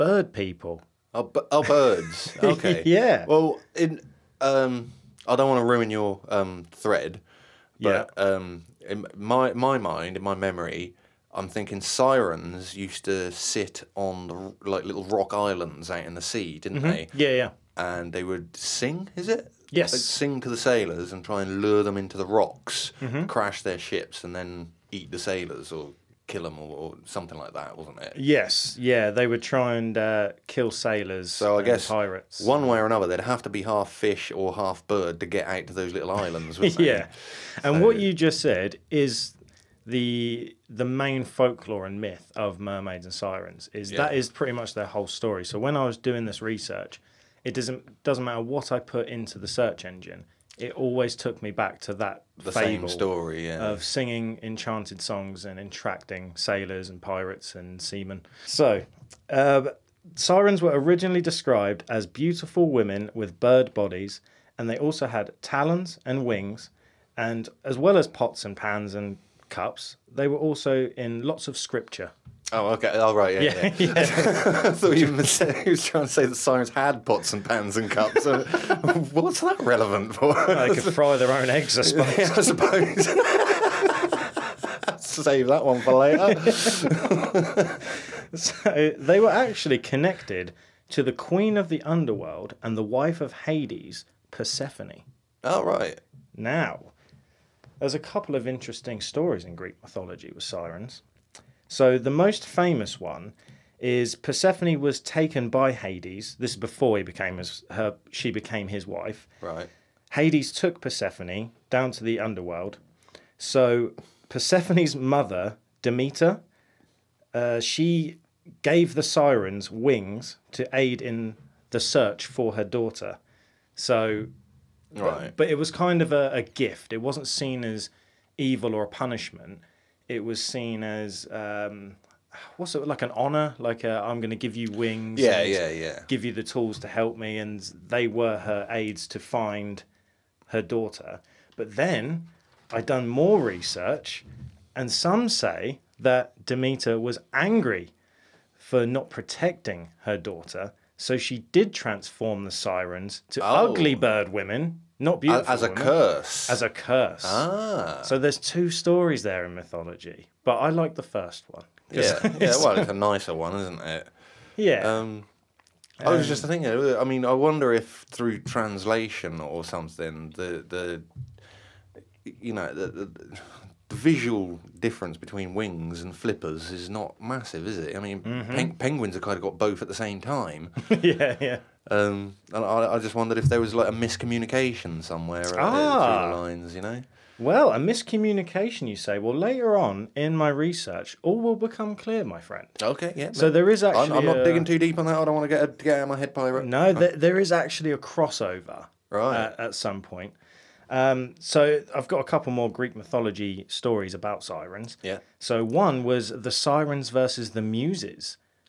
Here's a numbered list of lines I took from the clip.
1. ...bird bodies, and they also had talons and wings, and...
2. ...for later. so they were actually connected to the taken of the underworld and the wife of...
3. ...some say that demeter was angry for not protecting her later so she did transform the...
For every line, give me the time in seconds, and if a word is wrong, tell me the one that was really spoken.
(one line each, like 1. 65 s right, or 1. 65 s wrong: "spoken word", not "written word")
1. 63 s right
2. 85 s wrong: "queen", not "taken"
3. 144 s wrong: "daughter", not "later".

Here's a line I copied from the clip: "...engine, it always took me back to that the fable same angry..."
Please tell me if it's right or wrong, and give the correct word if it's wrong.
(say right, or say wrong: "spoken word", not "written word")
wrong: "story", not "angry".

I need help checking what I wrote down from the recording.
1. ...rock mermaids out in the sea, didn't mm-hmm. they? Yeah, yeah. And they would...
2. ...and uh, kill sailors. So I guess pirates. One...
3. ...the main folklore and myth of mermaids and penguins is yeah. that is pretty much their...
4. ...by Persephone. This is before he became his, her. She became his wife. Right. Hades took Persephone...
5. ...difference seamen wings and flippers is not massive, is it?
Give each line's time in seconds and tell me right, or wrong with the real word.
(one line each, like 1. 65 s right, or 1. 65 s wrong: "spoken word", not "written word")
1. 15 s wrong: "islands", not "mermaids"
2. 29 s right
3. 40 s wrong: "sirens", not "penguins"
4. 105 s wrong: "Hades", not "Persephone"
5. 174 s wrong: "between", not "seamen".